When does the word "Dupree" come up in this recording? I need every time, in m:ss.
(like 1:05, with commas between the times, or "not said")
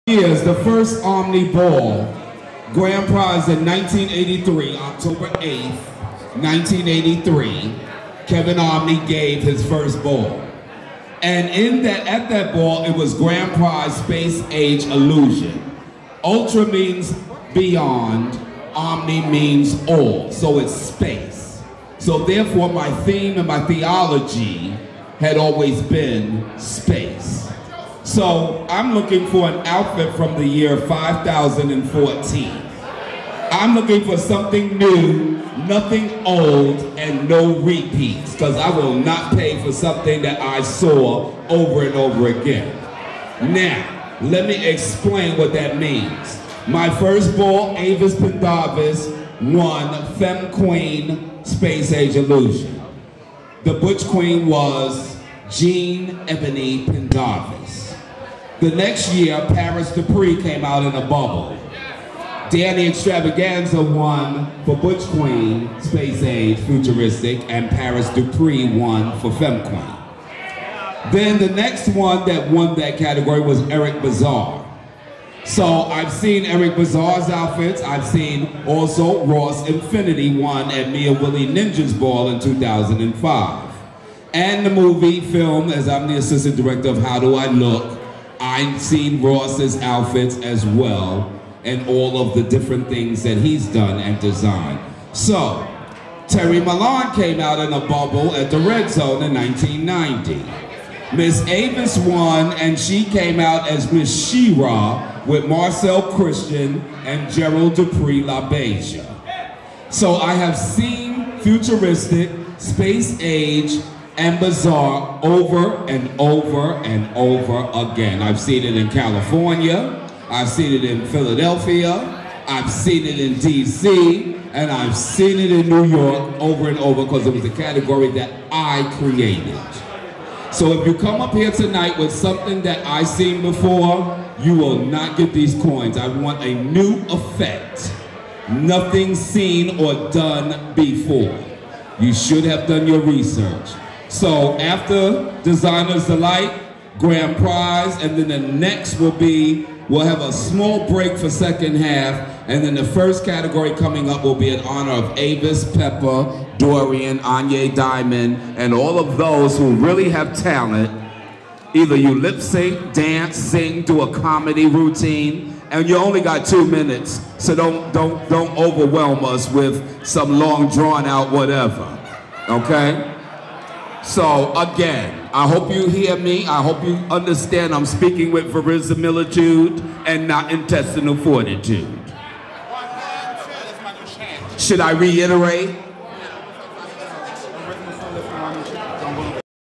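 0:59, 1:08, 1:47.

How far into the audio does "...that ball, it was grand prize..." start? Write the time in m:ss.
0:12.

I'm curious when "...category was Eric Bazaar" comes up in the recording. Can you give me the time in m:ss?
1:12.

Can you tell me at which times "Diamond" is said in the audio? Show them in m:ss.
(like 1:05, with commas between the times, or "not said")
2:37.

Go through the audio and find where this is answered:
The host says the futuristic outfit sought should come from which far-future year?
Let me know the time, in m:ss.
0:30.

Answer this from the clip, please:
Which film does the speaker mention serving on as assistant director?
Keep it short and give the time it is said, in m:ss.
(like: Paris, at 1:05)
How Do I Look, at 1:27.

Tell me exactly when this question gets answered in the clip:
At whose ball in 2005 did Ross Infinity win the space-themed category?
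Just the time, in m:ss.
1:20.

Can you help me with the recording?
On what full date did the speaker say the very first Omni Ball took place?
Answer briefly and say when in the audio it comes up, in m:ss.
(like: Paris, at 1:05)
October 8, 1983, at 0:04.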